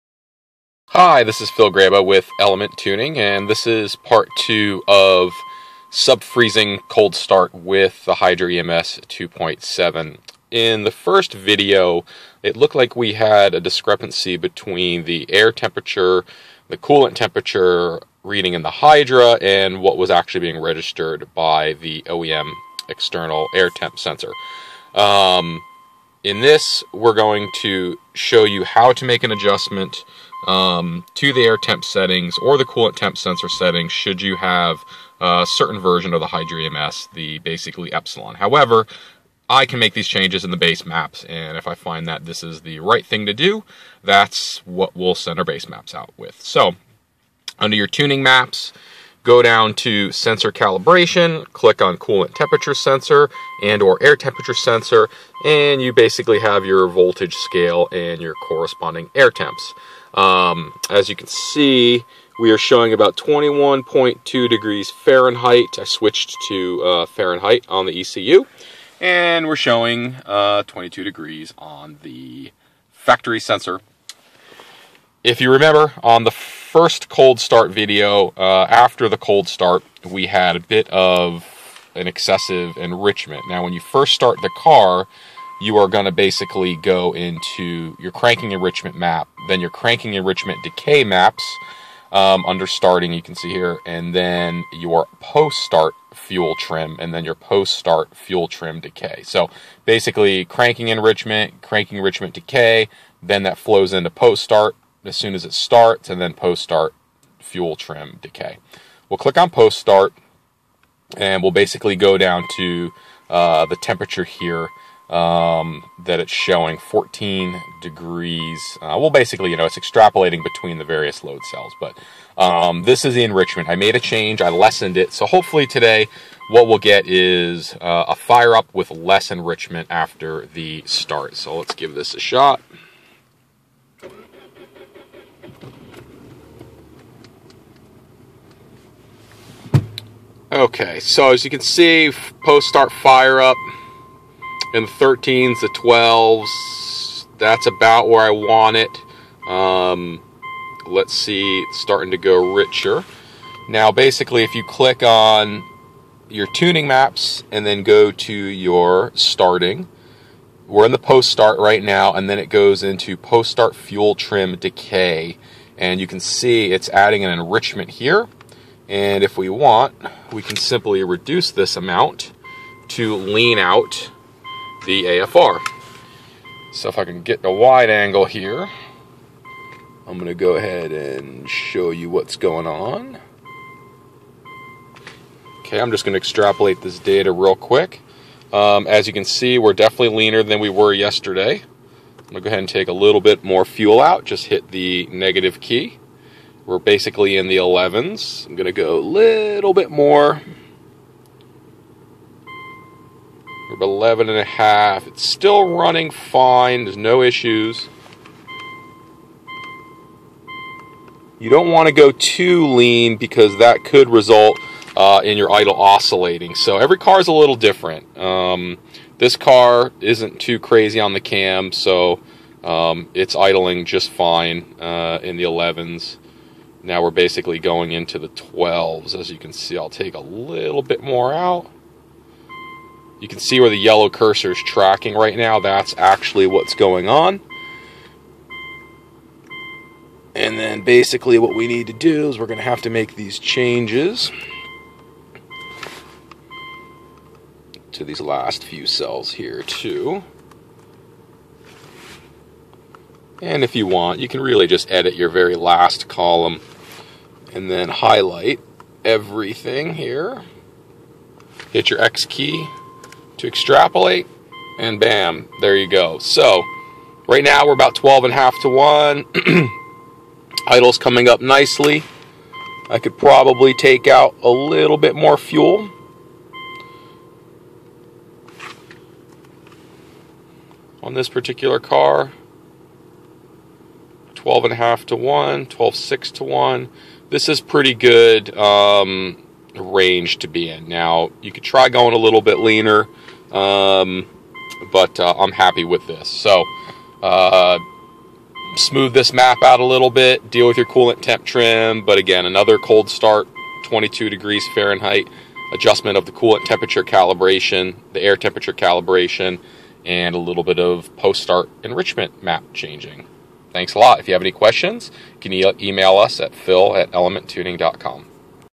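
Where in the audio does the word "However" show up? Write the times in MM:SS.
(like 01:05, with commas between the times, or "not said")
00:38.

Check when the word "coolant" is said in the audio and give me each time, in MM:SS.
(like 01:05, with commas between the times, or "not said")
00:16, 00:32, 00:51, 05:00, 05:06.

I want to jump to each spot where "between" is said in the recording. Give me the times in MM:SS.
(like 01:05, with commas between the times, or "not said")
00:14, 02:00.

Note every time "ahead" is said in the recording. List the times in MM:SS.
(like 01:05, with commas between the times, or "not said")
03:00, 03:12.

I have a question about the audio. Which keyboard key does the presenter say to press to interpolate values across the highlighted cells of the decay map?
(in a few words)
X.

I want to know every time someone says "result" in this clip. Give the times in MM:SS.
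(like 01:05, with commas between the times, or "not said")
03:34.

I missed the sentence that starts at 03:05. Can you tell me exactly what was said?
Okay, I'm just going to extrapolate this data real quick.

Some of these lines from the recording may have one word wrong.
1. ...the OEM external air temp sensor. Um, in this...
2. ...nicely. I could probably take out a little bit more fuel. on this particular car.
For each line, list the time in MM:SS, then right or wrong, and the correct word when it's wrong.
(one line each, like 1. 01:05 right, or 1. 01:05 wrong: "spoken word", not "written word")
1. 00:21 right
2. 04:31 right.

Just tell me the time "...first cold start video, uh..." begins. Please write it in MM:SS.
01:16.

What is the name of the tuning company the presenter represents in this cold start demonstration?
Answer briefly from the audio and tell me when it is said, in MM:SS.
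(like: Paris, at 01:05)
Element Tuning, at 00:02.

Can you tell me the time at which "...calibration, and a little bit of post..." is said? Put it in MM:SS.
05:08.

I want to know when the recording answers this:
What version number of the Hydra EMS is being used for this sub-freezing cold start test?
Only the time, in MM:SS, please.
00:09.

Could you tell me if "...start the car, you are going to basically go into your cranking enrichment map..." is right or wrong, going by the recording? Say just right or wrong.
right.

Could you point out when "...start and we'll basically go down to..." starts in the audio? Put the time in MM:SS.
01:49.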